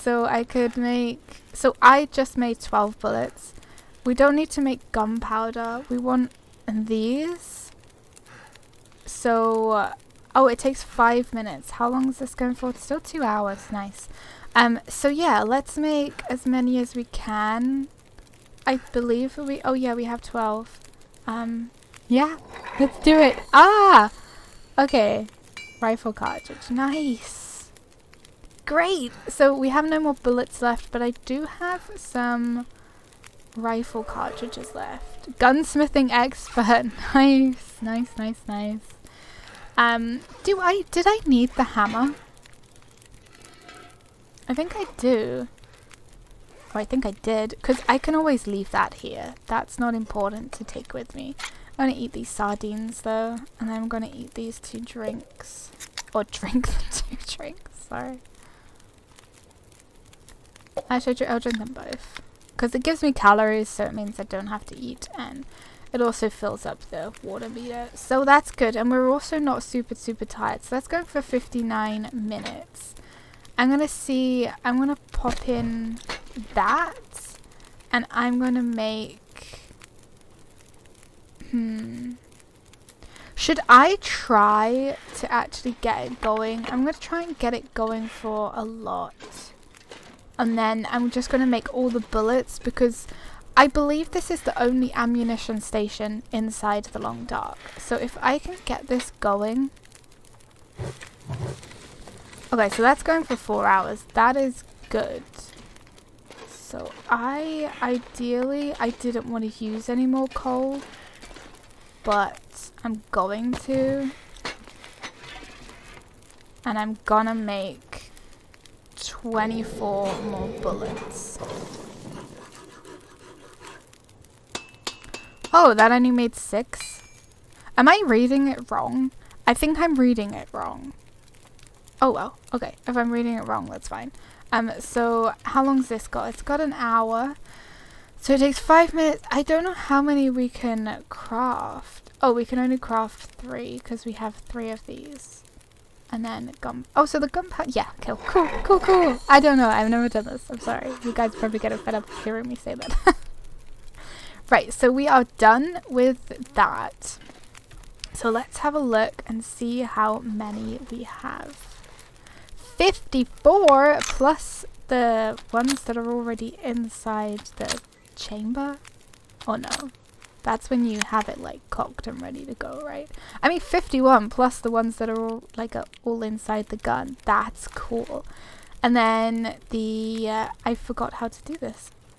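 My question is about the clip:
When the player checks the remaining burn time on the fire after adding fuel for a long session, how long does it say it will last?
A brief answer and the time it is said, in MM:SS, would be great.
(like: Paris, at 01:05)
4 hours, at 01:43.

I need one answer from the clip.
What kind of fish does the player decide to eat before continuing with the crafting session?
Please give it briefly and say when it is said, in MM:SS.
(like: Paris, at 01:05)
Sardines, at 00:52.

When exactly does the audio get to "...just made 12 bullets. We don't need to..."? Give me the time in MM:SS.
00:02.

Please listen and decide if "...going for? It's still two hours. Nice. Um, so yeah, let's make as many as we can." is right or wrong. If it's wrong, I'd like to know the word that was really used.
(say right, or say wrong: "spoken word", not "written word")
right.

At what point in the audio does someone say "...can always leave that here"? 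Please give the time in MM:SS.
00:47.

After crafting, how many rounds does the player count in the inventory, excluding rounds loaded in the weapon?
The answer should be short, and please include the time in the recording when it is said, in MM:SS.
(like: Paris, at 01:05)
51, at 02:53.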